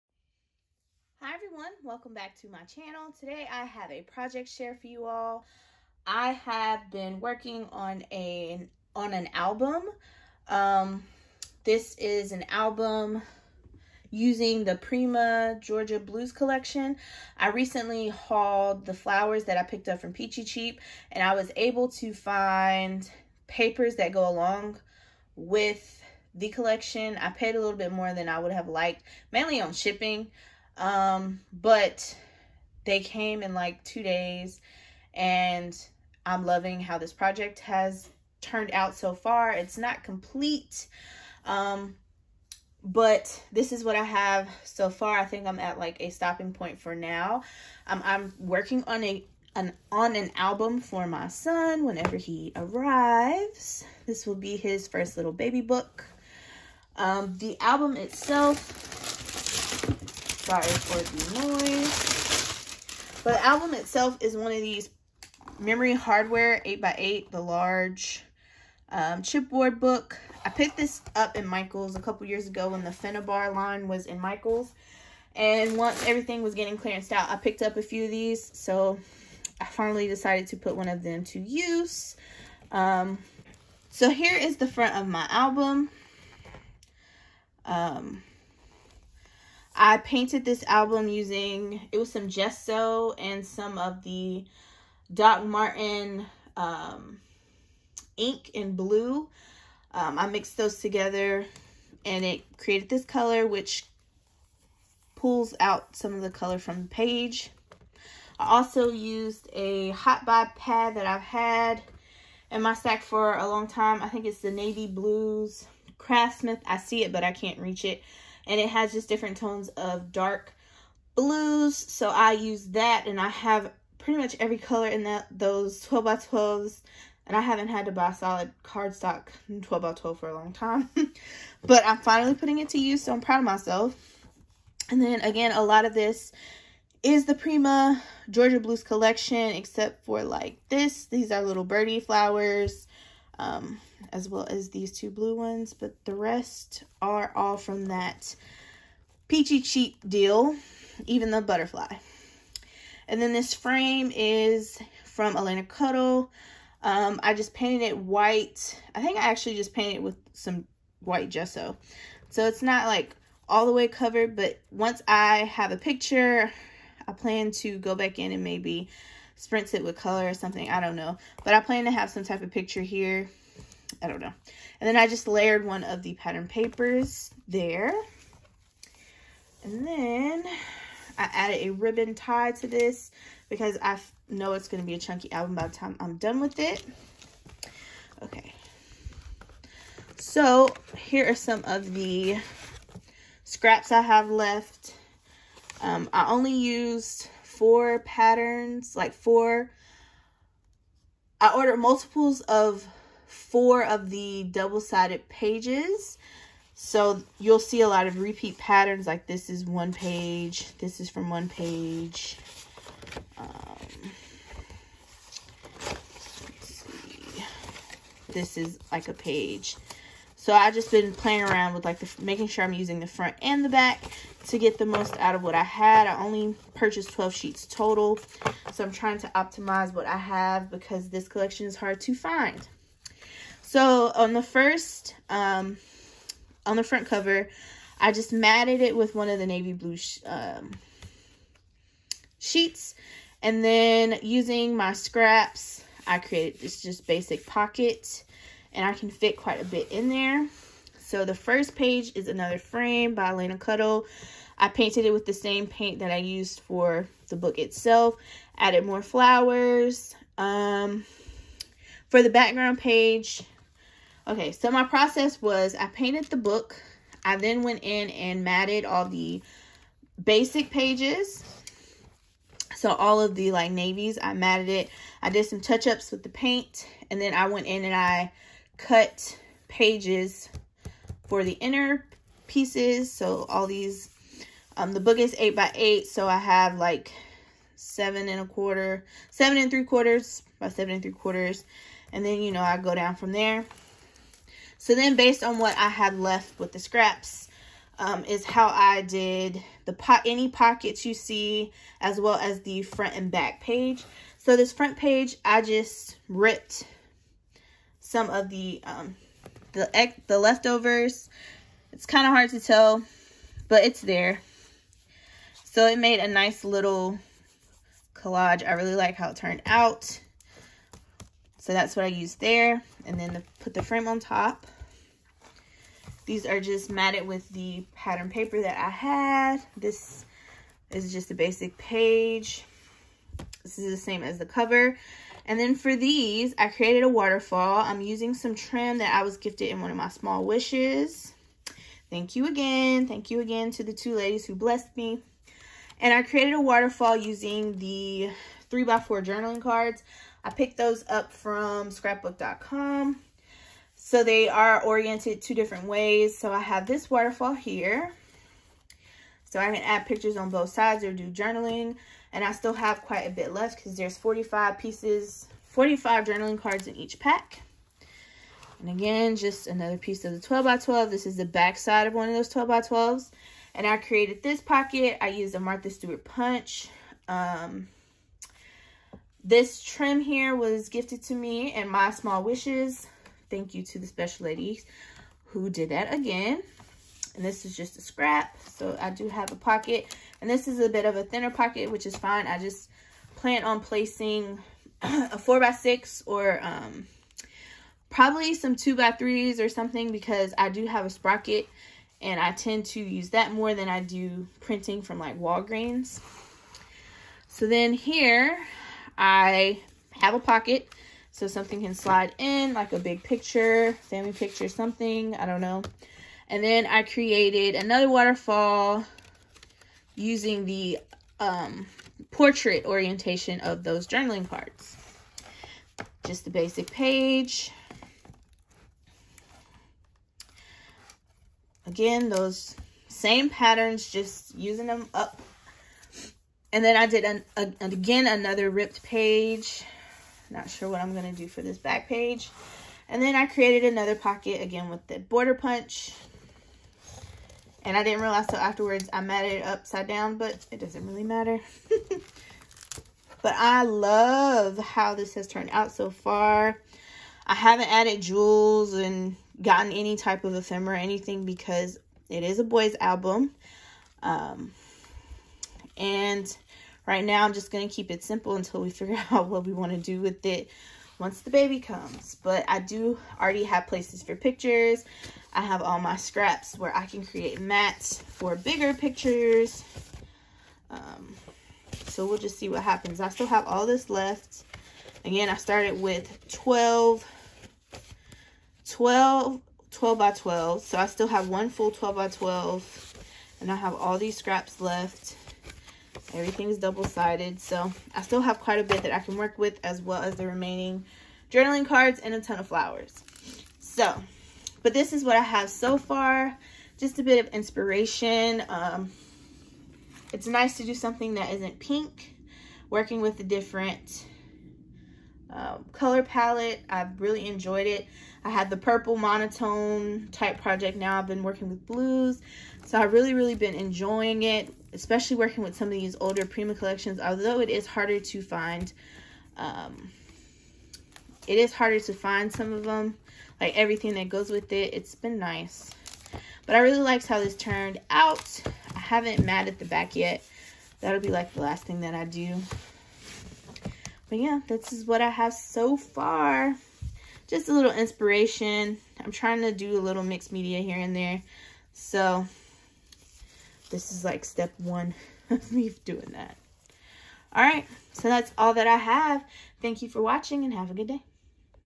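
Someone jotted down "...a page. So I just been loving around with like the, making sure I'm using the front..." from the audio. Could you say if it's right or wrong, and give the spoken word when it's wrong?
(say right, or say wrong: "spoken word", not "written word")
wrong: "playing", not "loving".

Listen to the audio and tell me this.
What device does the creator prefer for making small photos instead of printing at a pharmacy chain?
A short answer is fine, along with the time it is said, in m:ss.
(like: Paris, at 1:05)
Sprocket, at 6:41.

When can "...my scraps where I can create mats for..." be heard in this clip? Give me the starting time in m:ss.
7:56.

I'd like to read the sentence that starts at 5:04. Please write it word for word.
So this front page, I just ripped some of the um, the the leftovers.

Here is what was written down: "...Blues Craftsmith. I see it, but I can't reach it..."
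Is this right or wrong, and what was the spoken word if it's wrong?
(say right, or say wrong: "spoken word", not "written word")
right.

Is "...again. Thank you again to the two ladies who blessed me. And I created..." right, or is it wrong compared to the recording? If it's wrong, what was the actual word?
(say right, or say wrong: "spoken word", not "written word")
right.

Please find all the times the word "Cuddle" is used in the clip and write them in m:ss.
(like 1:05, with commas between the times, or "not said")
2:35, 4:13.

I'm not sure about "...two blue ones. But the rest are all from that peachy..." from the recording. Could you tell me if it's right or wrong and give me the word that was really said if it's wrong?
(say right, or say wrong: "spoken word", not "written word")
right.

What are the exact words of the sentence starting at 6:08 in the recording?
And again, just another piece of the 12 by 12.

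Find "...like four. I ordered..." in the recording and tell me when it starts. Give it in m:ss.
3:18.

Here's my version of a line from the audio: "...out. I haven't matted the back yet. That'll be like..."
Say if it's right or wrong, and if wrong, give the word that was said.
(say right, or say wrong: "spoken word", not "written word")
right.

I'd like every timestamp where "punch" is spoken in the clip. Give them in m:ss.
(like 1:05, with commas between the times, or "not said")
6:16, 7:25.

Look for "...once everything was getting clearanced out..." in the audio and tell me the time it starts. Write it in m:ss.
1:15.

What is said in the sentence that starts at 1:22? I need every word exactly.
Um, so here is the front of my album.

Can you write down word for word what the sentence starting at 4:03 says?
And then using my scraps, I created this just basic pocket and I can fit quite a bit in there.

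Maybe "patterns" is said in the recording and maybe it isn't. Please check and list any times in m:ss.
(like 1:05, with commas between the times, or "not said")
2:56, 3:17, 3:28, 5:27, 7:13.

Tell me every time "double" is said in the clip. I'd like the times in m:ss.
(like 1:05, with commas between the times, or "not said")
3:24, 8:16.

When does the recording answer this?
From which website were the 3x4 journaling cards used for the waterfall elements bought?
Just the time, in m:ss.
5:51.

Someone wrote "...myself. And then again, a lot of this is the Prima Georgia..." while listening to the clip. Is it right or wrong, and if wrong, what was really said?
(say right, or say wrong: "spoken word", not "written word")
right.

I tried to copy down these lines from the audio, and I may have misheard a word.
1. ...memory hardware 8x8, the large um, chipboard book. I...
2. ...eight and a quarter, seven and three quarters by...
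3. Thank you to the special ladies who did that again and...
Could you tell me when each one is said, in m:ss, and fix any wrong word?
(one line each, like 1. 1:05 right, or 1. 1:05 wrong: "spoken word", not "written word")
1. 1:05 right
2. 4:47 wrong: "seven", not "eight"
3. 6:23 right.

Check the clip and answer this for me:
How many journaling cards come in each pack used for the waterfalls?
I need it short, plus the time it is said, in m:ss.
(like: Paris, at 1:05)
45, at 6:05.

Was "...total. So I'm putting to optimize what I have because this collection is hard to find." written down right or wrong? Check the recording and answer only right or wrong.
wrong.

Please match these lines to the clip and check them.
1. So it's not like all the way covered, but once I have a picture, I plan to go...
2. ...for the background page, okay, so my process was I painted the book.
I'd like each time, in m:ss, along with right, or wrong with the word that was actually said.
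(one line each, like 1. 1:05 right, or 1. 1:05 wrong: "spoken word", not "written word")
1. 2:42 right
2. 4:22 right.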